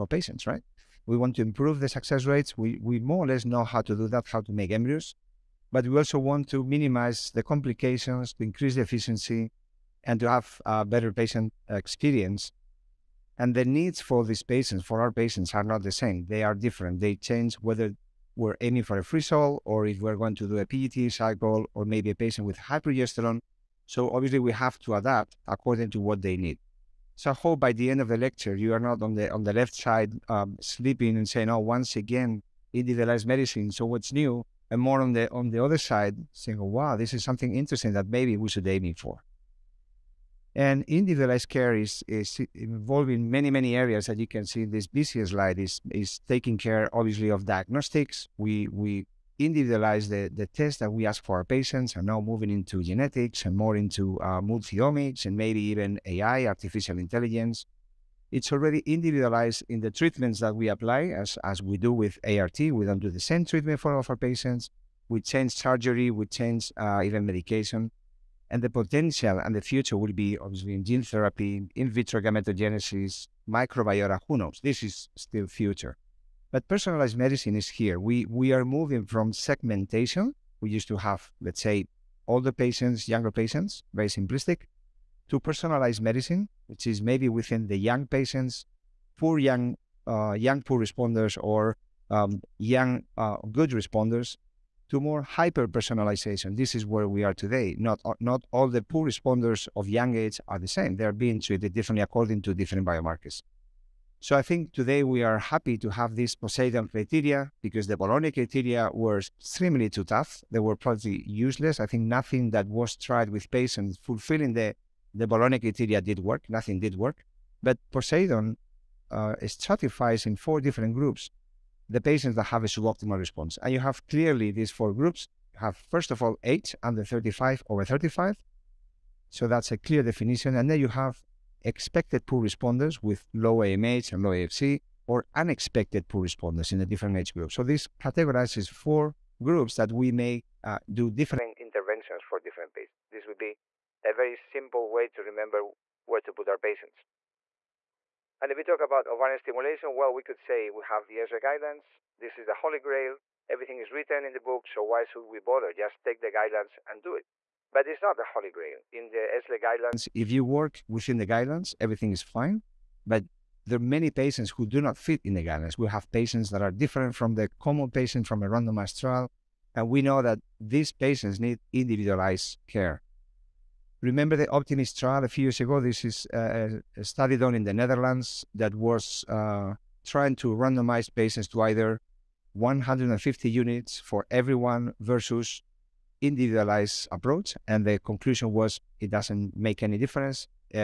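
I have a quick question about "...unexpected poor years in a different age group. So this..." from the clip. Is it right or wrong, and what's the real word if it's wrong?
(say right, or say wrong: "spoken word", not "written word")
wrong: "responders", not "years".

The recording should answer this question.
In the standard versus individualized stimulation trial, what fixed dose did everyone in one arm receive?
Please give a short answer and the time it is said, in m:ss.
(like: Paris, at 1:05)
150 units, at 3:02.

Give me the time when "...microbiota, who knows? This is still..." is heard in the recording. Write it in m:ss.
1:13.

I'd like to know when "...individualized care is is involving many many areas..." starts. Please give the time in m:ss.
0:40.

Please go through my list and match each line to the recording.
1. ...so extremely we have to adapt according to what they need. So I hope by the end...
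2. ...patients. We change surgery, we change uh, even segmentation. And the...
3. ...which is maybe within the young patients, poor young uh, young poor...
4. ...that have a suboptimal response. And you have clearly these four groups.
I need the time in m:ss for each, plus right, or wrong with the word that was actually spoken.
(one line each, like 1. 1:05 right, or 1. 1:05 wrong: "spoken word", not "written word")
1. 0:23 wrong: "obviously", not "extremely"
2. 1:04 wrong: "medication", not "segmentation"
3. 1:26 right
4. 2:02 right.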